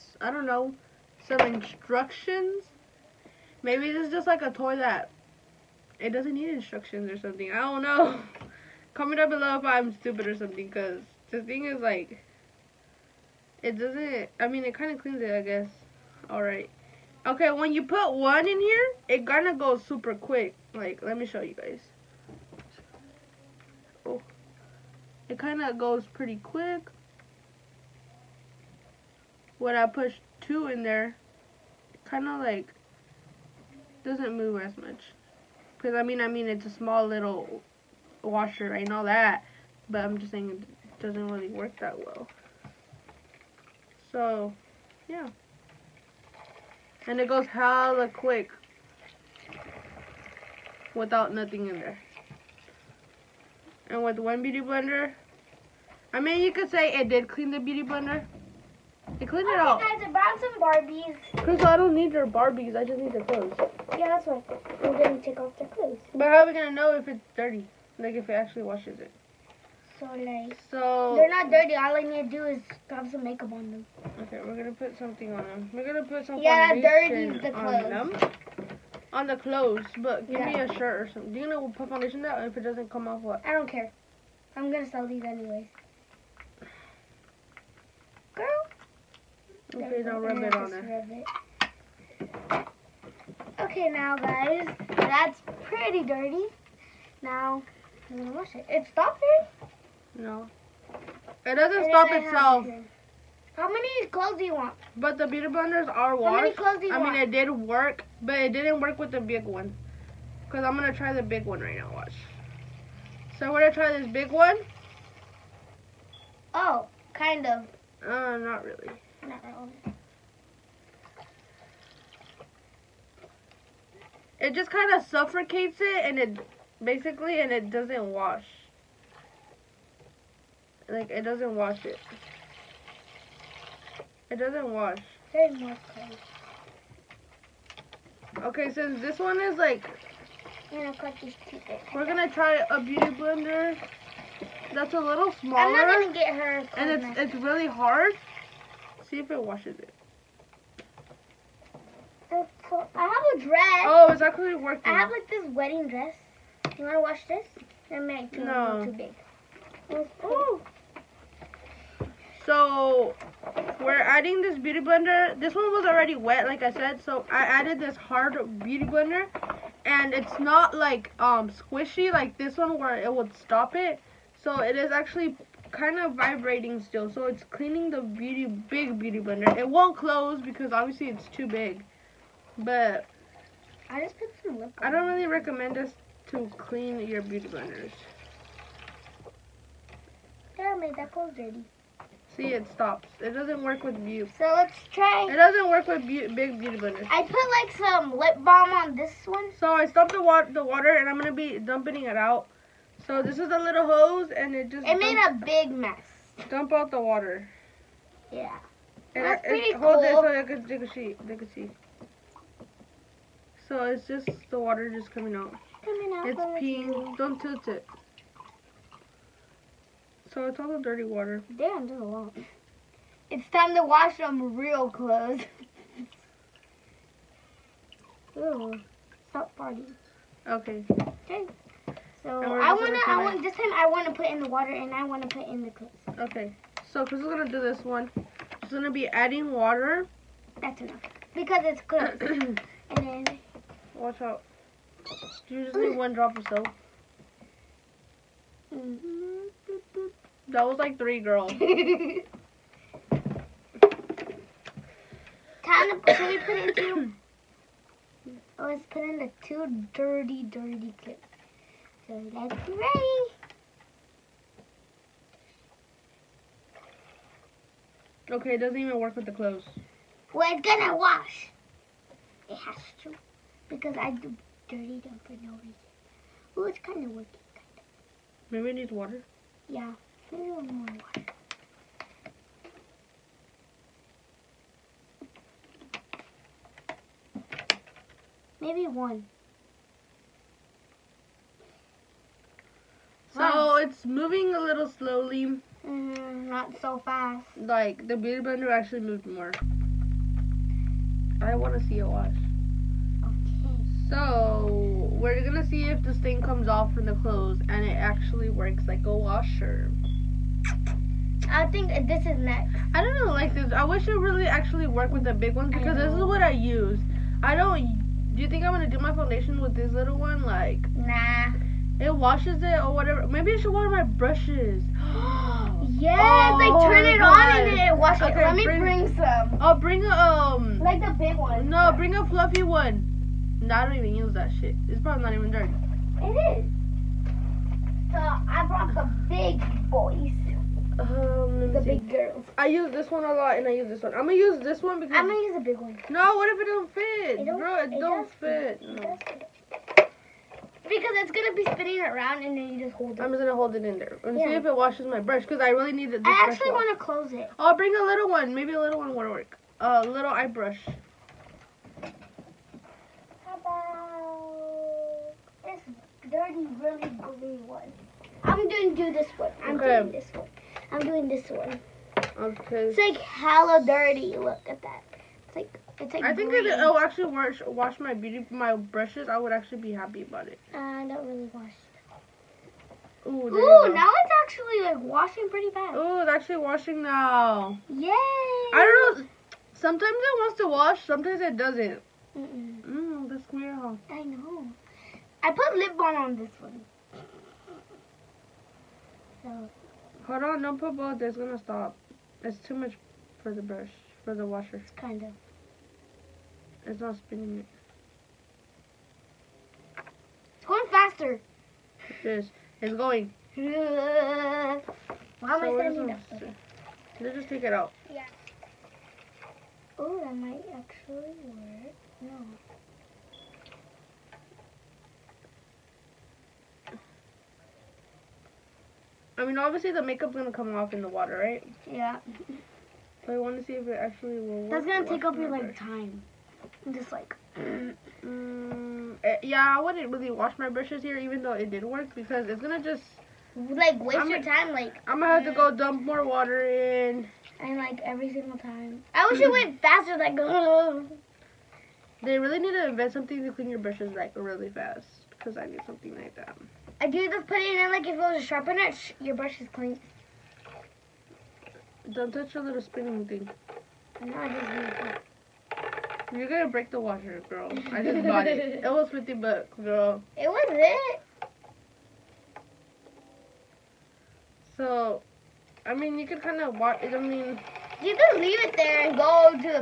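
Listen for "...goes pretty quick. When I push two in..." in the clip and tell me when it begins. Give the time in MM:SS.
00:25.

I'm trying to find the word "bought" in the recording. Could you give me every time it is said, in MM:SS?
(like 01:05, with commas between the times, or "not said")
07:48.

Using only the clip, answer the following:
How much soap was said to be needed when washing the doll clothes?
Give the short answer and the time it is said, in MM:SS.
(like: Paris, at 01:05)
One drop, at 04:05.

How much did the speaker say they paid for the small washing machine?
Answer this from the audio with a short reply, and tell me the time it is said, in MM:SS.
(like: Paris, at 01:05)
50 bucks, at 07:49.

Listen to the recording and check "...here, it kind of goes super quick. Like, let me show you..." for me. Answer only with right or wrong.
right.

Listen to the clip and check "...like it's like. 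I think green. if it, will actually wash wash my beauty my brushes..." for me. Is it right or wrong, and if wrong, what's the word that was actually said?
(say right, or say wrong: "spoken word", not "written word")
right.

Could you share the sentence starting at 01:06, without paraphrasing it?
But how are we going to know if it's dirty?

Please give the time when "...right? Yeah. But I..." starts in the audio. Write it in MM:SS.
07:11.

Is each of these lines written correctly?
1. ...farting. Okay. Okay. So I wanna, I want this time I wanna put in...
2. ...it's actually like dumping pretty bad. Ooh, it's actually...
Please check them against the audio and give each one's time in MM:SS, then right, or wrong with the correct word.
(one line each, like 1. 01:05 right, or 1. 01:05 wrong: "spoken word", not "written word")
1. 03:49 right
2. 06:24 wrong: "washing", not "dumping".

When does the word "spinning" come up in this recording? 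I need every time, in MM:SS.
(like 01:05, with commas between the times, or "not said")
05:51, 06:47, 07:42.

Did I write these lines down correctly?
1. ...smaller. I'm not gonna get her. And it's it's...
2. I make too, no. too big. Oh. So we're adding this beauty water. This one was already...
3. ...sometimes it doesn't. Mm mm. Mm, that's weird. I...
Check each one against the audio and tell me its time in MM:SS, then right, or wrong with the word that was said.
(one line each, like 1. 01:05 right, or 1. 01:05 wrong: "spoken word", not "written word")
1. 02:25 right
2. 02:37 wrong: "blender", not "water"
3. 06:31 right.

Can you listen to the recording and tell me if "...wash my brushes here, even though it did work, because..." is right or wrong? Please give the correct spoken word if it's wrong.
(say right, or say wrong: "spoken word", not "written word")
right.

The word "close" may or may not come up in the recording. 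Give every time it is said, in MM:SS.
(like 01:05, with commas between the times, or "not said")
02:59, 05:57.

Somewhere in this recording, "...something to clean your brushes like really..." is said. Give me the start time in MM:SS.
07:33.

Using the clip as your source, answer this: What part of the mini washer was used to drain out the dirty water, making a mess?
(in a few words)
A little hose.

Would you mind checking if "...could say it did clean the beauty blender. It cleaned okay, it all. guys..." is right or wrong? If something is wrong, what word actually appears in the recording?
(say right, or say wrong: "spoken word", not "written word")
right.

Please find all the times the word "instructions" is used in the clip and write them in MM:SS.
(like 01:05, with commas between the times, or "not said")
00:01, 00:06.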